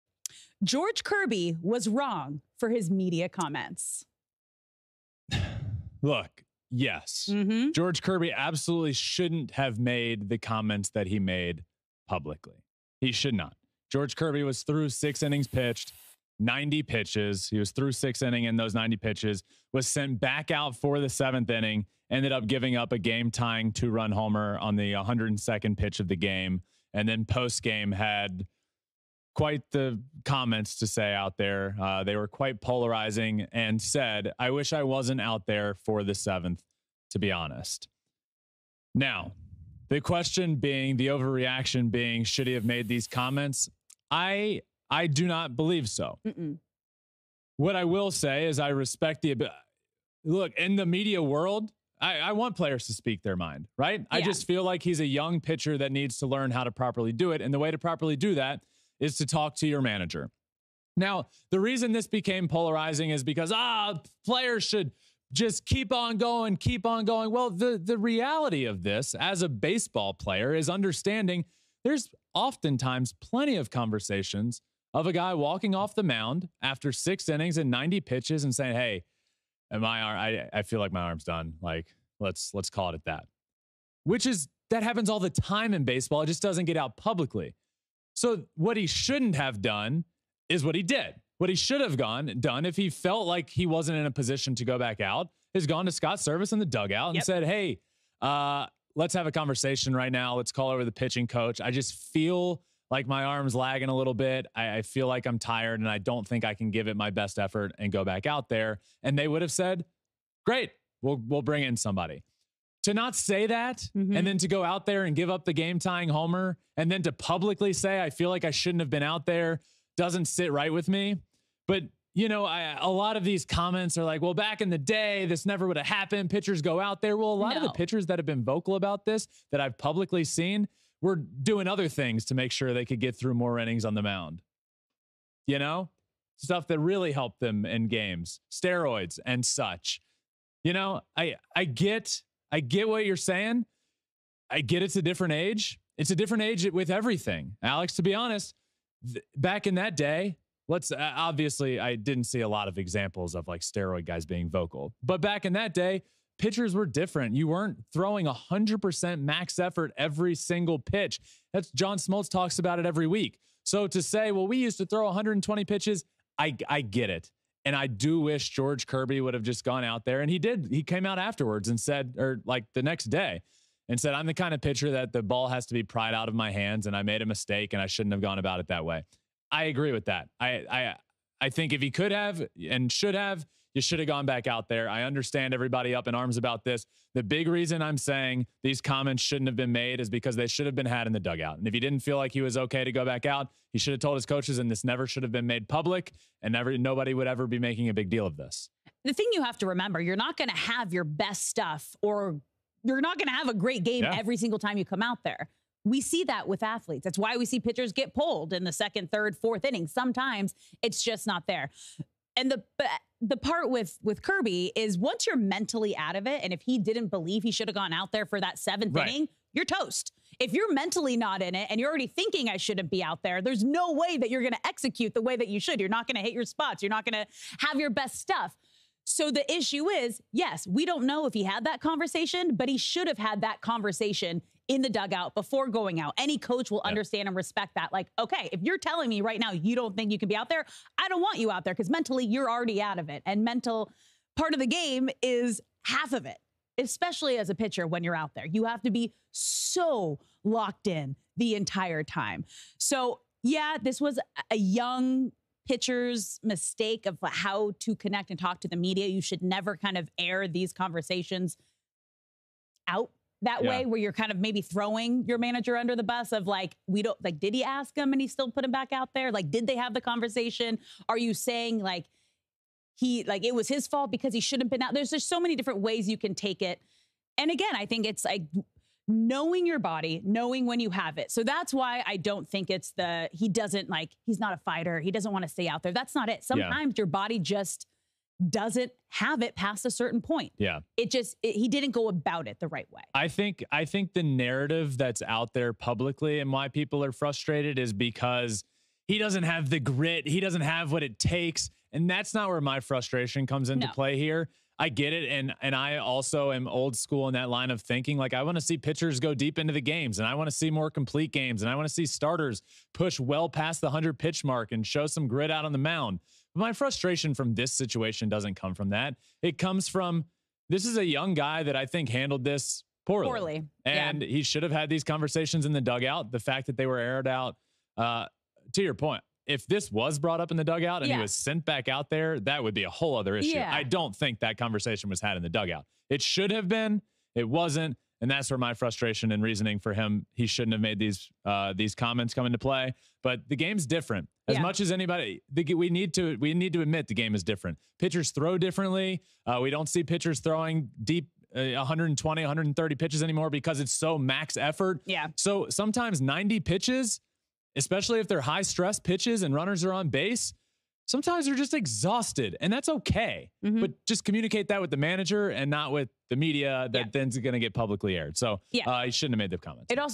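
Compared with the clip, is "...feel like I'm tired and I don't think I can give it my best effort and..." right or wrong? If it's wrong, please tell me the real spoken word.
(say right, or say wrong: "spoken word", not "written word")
right.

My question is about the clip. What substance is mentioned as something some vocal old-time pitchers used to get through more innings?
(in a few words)
Steroids.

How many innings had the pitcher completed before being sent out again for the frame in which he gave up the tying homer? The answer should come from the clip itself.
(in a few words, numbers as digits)
6.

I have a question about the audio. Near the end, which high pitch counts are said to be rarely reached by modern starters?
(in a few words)
120, 130.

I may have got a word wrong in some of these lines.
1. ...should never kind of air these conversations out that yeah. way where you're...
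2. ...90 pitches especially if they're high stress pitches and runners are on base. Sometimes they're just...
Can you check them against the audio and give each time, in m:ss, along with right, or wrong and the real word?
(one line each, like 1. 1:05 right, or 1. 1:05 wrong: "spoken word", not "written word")
1. 4:19 right
2. 5:56 right.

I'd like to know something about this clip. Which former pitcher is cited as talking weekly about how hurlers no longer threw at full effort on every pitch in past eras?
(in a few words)
John Smoltz.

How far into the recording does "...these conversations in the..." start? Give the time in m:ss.
5:24.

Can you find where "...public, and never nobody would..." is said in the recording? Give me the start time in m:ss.
3:15.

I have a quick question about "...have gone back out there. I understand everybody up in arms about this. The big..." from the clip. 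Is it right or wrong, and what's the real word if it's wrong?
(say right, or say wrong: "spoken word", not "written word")
right.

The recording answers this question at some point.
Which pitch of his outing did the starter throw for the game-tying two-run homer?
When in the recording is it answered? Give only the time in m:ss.
0:24.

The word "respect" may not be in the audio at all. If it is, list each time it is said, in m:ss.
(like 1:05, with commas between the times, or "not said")
0:48, 3:57.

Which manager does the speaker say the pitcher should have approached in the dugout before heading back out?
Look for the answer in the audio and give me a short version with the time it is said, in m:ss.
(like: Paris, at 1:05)
Scott Servais, at 1:35.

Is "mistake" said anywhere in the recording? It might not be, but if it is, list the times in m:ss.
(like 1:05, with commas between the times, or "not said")
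2:57, 4:16.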